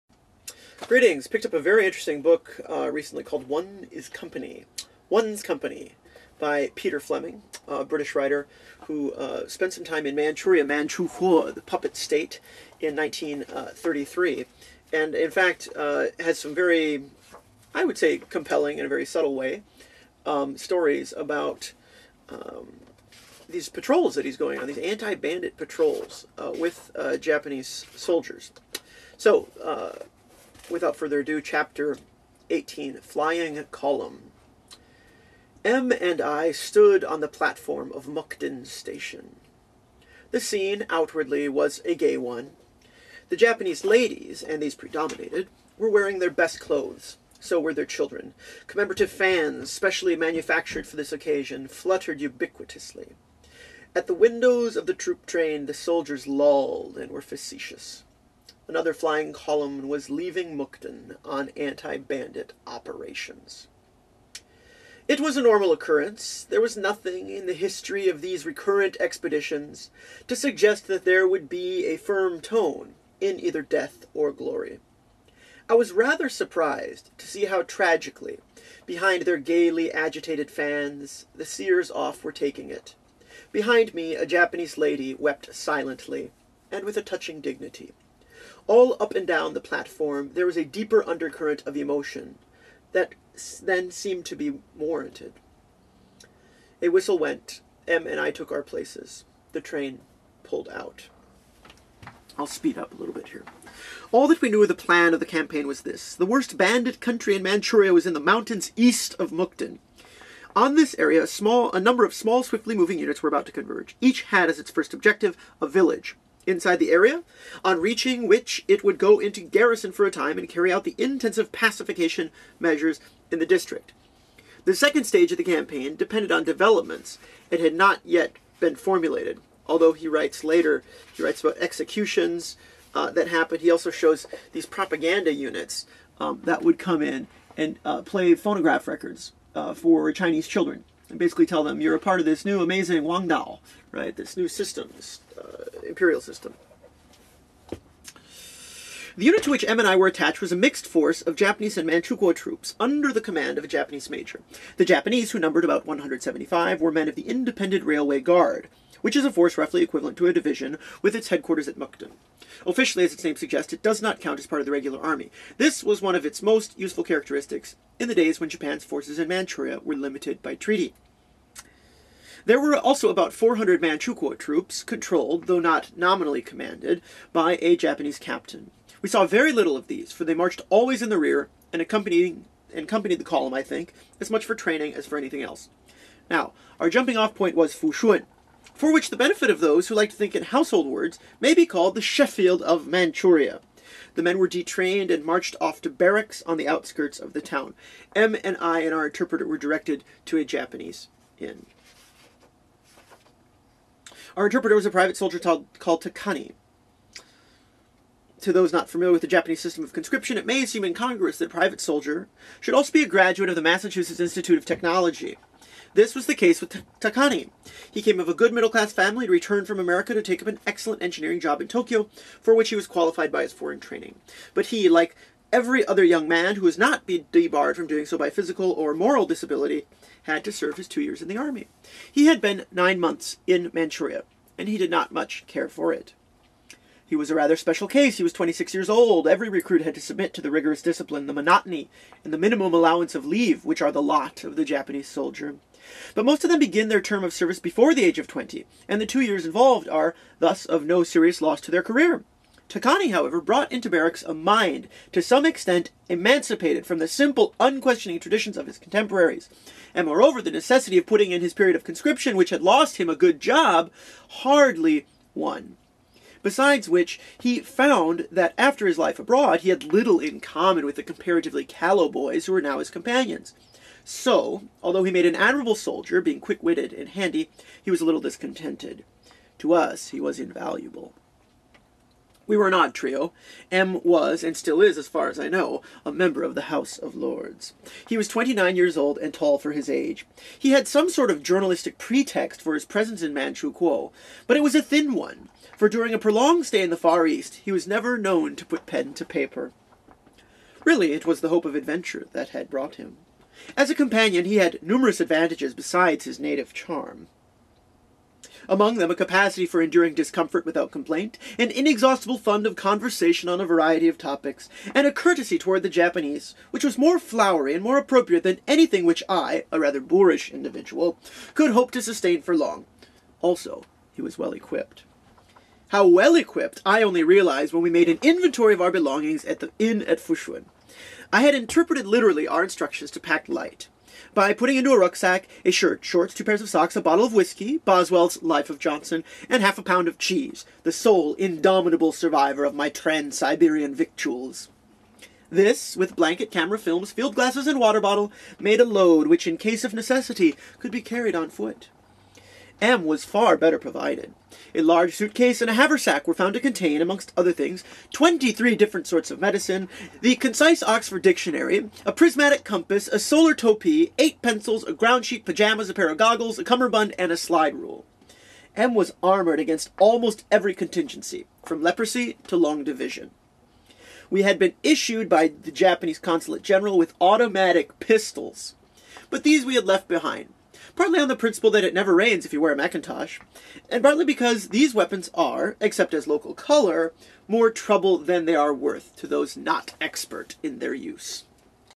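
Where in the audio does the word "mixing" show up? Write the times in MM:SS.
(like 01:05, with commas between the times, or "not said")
not said.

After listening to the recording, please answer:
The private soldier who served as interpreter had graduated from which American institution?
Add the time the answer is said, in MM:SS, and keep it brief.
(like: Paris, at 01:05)
Massachusetts Institute of Technology, at 03:33.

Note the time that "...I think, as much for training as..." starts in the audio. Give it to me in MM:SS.
03:03.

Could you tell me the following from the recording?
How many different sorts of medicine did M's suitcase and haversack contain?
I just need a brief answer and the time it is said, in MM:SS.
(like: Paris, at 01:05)
23, at 05:58.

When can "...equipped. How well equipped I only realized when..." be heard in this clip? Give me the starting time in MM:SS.
05:24.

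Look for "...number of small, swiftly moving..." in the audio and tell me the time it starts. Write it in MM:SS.
01:51.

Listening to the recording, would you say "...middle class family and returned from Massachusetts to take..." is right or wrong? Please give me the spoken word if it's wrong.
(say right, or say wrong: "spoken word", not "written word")
wrong: "America", not "Massachusetts".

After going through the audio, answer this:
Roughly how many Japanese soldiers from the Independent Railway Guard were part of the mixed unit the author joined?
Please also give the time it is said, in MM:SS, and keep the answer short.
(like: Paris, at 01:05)
175, at 02:35.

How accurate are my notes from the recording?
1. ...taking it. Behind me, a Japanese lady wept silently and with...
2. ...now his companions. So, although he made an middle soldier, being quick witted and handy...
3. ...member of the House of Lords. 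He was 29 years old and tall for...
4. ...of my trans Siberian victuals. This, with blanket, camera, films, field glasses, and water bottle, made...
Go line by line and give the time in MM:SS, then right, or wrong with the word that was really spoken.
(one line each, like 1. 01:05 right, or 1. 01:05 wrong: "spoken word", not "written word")
1. 01:22 right
2. 04:32 wrong: "admirable", not "middle"
3. 04:46 right
4. 05:42 right.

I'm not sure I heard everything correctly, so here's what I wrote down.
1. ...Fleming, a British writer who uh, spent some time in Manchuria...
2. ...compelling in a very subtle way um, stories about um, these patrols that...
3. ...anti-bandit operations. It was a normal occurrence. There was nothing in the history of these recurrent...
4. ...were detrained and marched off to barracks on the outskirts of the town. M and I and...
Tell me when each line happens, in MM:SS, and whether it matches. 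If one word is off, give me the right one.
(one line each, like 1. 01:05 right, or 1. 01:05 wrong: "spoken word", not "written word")
1. 00:06 right
2. 00:18 right
3. 01:01 right
4. 03:14 right.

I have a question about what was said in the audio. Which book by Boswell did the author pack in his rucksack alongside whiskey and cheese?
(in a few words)
Life of Johnson.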